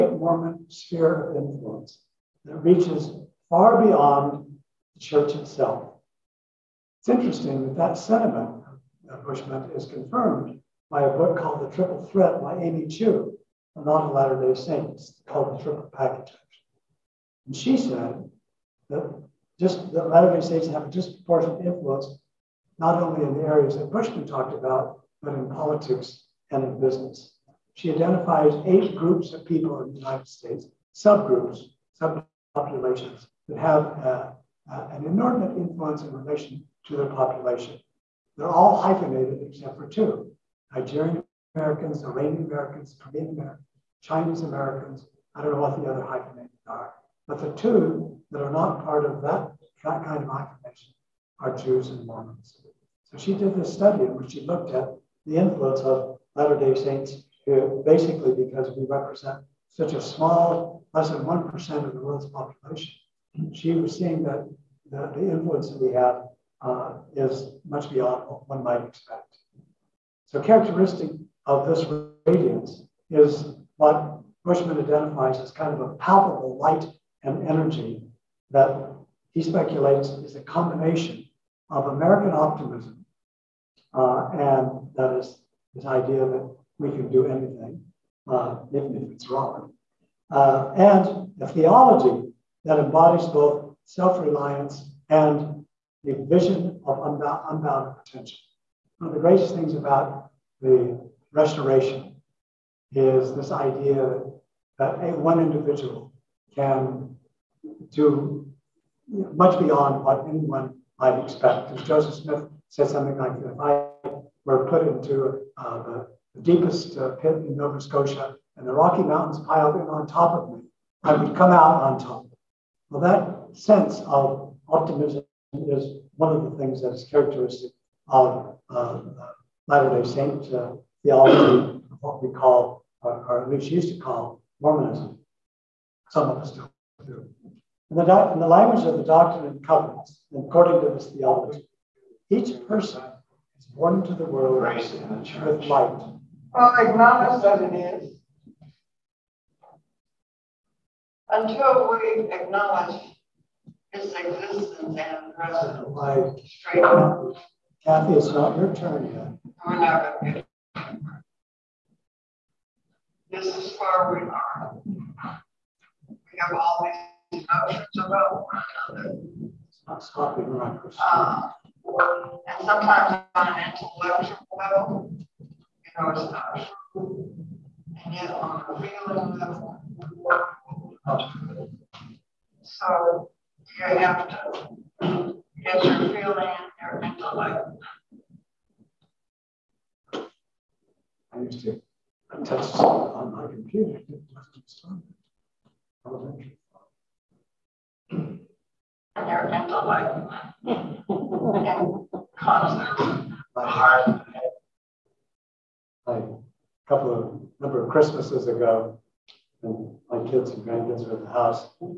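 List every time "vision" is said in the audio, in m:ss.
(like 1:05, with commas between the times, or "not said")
1:36.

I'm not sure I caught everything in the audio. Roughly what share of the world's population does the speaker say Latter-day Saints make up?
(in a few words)
Less than 1%.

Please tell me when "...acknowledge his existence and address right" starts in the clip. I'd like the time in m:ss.
2:32.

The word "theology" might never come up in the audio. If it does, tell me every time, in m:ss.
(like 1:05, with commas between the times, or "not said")
1:31, 2:11, 2:21.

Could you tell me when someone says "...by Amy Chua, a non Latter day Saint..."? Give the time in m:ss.
0:12.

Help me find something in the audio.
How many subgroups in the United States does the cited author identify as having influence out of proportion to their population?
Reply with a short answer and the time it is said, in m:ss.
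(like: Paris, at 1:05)
8, at 0:28.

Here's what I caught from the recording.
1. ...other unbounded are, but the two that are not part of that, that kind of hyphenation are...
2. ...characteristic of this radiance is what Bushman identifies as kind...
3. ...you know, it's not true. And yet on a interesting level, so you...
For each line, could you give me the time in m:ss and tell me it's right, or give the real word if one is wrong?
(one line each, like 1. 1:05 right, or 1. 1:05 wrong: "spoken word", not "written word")
1. 0:45 wrong: "hyphenated", not "unbounded"
2. 1:10 right
3. 2:55 wrong: "feeling", not "interesting".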